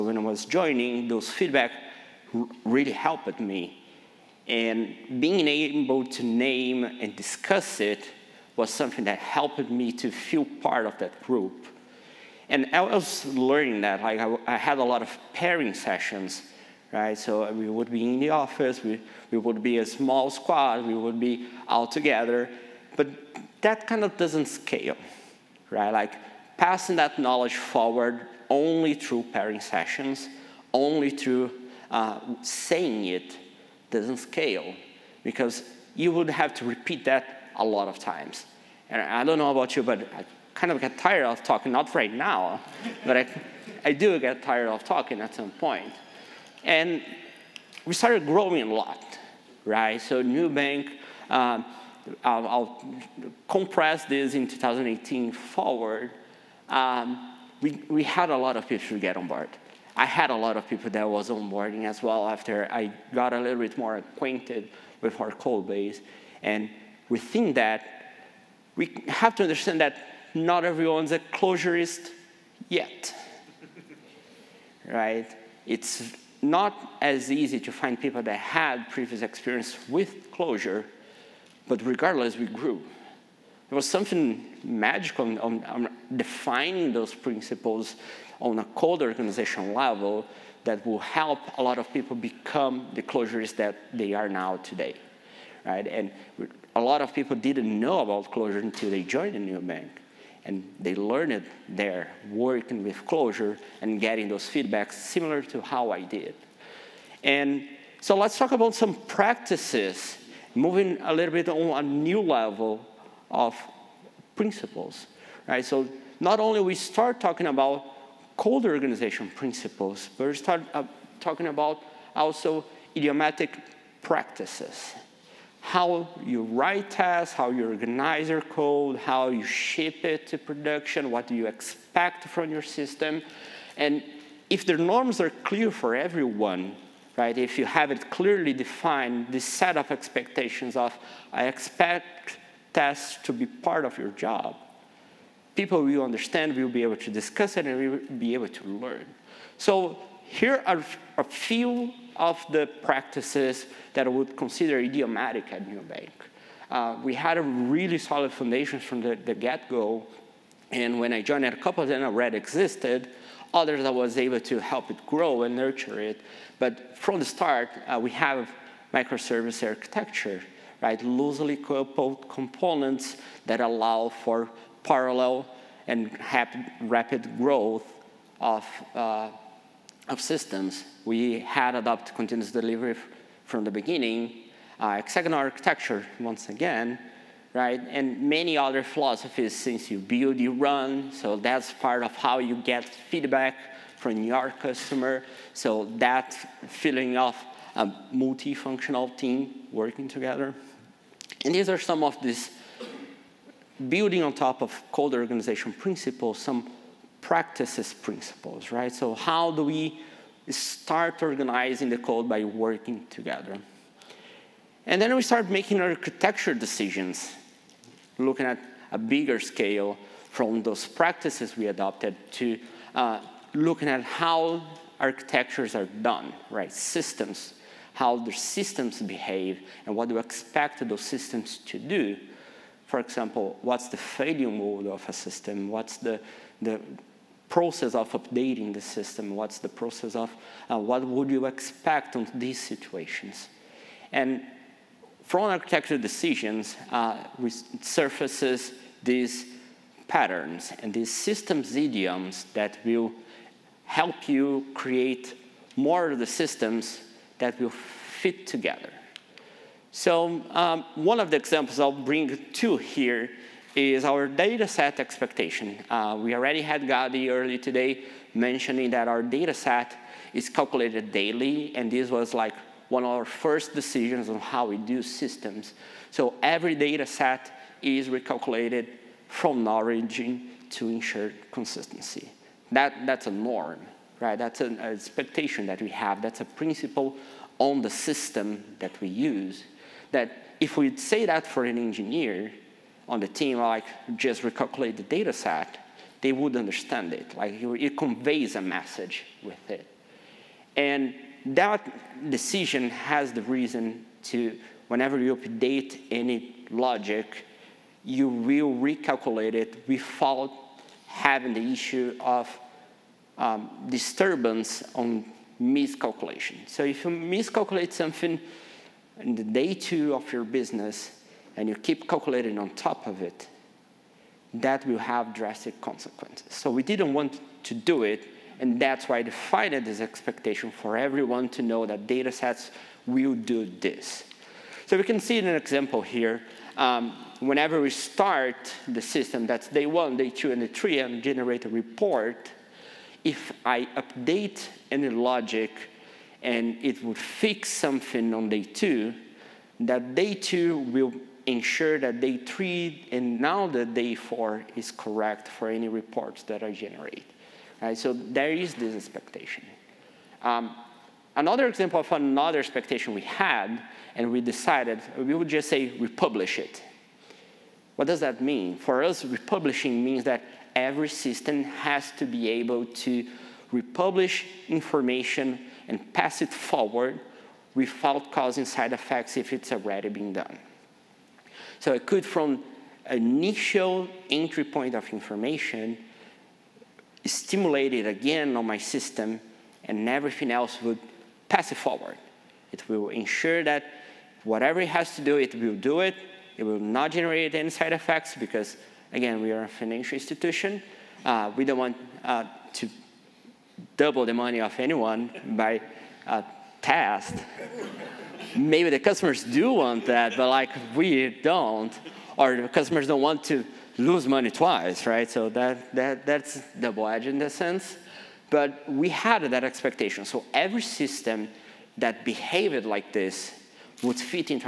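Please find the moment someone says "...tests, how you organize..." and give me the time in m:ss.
2:06.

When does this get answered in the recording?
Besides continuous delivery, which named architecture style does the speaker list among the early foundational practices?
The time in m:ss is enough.
3:04.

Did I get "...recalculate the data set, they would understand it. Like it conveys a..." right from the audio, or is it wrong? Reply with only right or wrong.
right.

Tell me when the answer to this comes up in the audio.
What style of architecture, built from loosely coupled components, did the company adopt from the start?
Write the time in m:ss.
2:48.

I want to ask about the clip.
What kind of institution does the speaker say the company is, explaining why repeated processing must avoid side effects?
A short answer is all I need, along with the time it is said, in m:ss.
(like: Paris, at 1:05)
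Financial institution, at 6:39.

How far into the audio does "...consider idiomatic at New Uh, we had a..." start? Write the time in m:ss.
2:34.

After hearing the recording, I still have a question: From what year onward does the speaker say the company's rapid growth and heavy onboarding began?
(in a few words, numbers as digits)
2018.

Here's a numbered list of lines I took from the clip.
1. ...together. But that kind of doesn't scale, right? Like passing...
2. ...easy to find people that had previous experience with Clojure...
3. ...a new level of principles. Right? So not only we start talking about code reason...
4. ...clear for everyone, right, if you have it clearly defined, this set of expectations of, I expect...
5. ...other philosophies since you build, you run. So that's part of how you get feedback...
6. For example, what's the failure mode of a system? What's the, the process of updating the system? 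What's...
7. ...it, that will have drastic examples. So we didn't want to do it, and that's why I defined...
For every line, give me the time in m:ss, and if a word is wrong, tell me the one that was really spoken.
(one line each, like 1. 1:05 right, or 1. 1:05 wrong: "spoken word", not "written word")
1. 0:21 right
2. 1:17 right
3. 1:51 wrong: "organization", not "reason"
4. 2:15 right
5. 3:08 right
6. 3:52 right
7. 5:23 wrong: "consequences", not "examples".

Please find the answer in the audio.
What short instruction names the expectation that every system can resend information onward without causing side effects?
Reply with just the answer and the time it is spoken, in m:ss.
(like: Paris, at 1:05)
Republish it, at 6:05.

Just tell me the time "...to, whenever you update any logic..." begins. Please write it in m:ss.
5:04.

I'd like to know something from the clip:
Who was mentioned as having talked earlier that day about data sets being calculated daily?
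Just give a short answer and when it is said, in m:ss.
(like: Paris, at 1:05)
Gadi, at 4:26.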